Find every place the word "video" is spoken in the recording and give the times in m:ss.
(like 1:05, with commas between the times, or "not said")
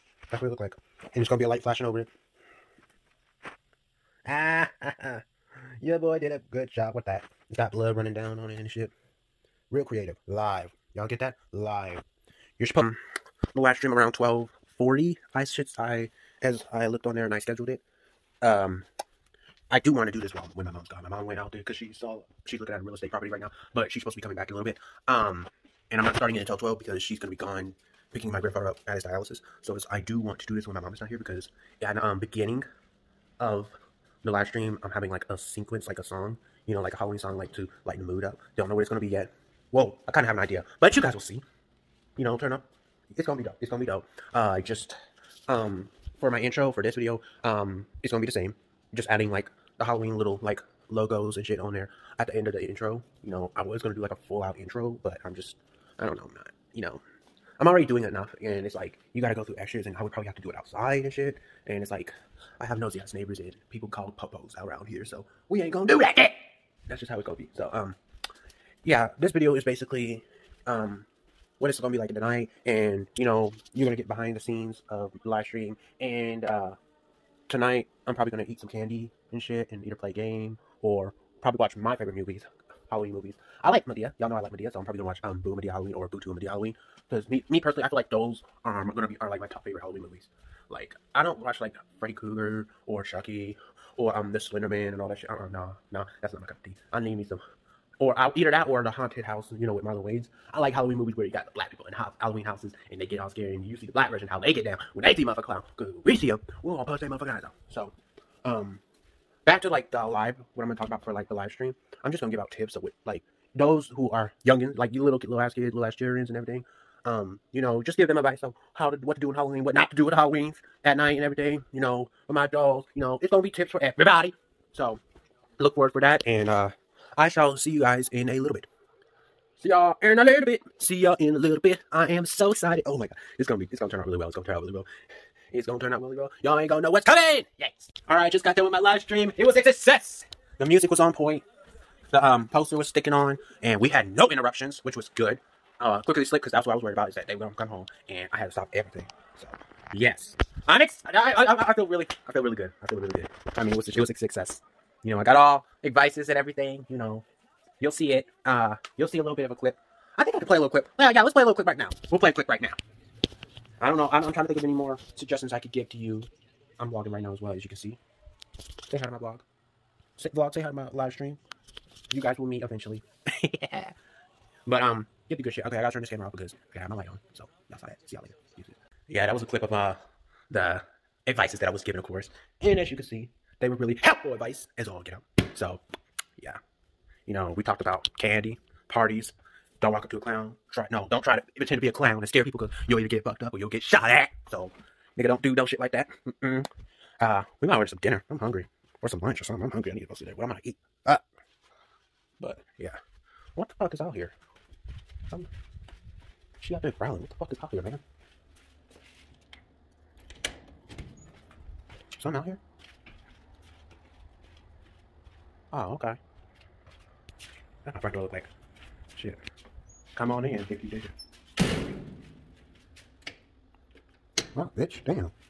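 0:46, 1:09.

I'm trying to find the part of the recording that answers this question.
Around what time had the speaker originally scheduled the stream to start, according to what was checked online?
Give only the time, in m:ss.
0:14.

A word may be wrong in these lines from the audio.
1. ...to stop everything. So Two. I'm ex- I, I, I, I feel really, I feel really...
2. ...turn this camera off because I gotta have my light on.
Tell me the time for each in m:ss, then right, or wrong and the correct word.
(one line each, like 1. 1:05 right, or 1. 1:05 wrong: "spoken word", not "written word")
1. 2:28 wrong: "Yes", not "Two"
2. 2:55 right.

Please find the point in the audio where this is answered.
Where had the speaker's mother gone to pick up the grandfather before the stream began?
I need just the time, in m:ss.
0:29.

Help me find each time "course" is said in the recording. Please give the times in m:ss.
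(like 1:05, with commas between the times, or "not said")
3:02.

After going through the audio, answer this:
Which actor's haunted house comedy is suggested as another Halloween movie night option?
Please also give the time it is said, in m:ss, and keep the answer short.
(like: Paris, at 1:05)
Marlon Wayans, at 1:39.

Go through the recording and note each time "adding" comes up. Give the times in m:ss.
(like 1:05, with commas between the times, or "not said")
0:49.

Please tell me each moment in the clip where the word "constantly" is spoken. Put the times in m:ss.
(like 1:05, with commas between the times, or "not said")
not said.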